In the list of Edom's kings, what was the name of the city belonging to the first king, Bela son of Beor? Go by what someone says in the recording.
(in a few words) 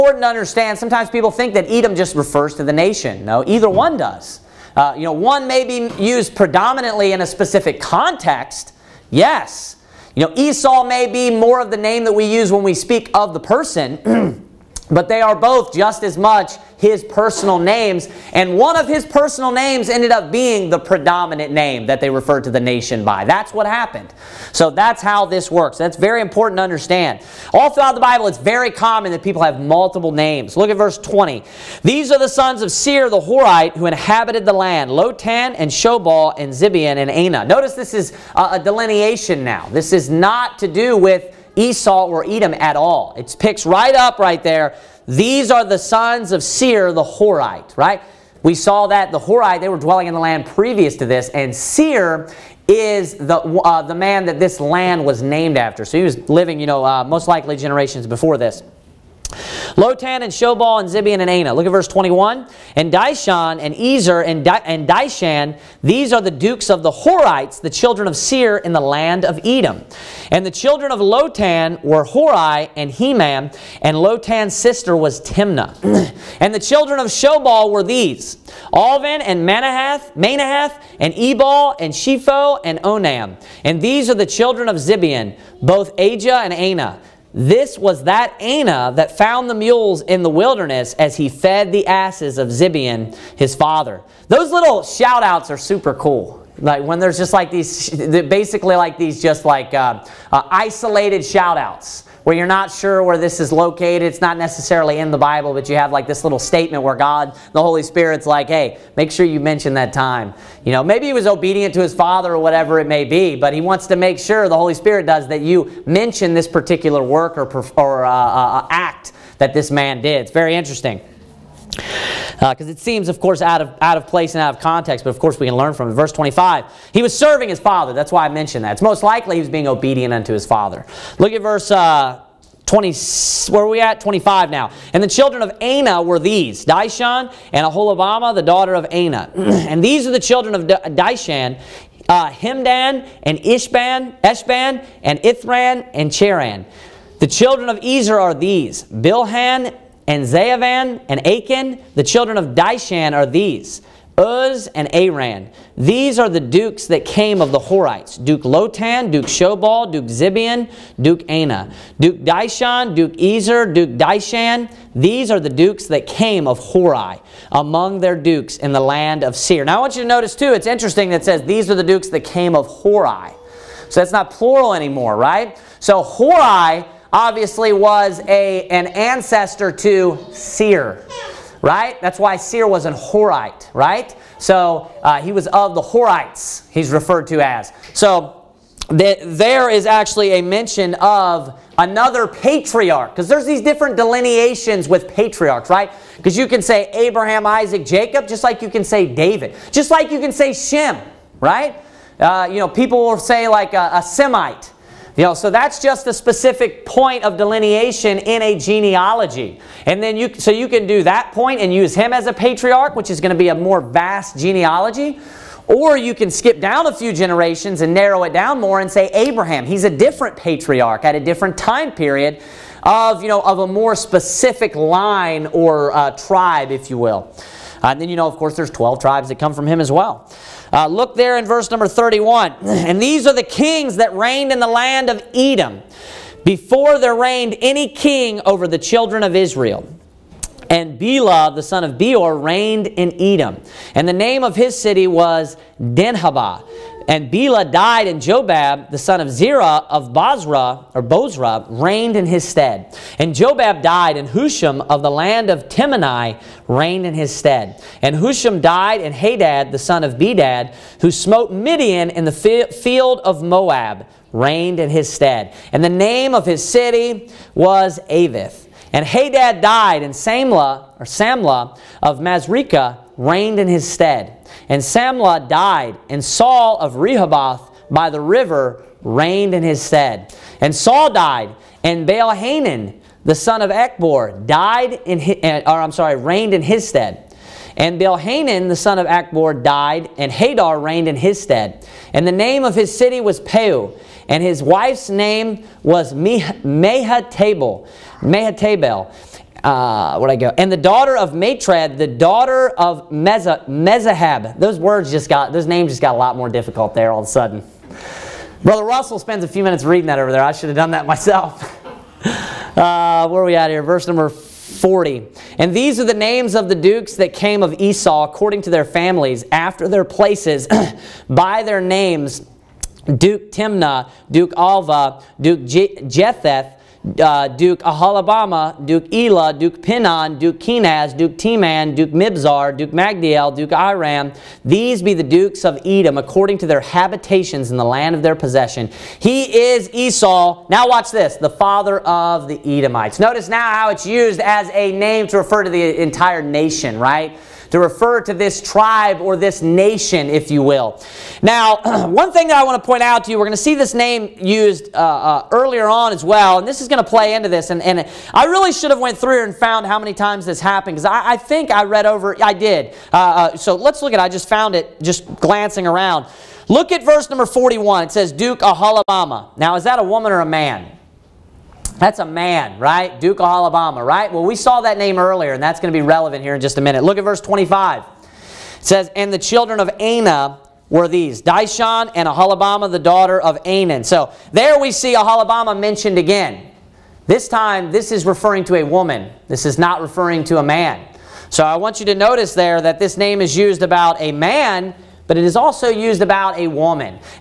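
Denhabah.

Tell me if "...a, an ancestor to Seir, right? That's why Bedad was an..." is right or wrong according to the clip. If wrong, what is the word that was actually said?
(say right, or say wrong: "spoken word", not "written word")
wrong: "Seir", not "Bedad".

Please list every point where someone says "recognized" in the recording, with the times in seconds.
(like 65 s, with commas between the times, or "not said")
not said.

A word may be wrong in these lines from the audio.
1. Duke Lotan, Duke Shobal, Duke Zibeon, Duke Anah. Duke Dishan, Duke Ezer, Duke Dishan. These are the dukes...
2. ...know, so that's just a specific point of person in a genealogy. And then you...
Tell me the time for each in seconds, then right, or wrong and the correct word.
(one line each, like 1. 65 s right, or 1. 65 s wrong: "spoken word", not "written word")
1. 158 s right
2. 205 s wrong: "delineation", not "person".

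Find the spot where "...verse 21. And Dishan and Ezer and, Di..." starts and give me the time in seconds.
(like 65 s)
61 s.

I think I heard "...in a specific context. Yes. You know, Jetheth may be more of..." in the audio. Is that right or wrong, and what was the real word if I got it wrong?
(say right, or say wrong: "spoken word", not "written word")
wrong: "Esau", not "Jetheth".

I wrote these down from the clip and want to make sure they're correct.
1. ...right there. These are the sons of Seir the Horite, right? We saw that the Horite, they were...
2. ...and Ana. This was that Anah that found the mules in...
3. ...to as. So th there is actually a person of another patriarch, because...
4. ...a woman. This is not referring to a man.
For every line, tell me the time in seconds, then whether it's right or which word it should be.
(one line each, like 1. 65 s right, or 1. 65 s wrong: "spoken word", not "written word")
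1. 44 s right
2. 86 s right
3. 187 s wrong: "mention", not "person"
4. 388 s right.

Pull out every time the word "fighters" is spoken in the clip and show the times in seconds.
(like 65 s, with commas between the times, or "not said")
not said.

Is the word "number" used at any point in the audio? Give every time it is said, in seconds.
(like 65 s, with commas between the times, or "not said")
231 s, 314 s, 367 s.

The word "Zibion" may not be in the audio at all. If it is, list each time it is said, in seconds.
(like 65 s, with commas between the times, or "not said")
60 s, 84 s.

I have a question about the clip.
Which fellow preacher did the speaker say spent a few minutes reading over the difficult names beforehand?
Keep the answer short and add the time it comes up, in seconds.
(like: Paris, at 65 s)
Brother Russell, at 308 s.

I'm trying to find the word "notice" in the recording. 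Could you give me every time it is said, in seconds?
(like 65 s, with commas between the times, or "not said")
37 s, 170 s, 343 s, 392 s.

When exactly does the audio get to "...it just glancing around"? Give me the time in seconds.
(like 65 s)
364 s.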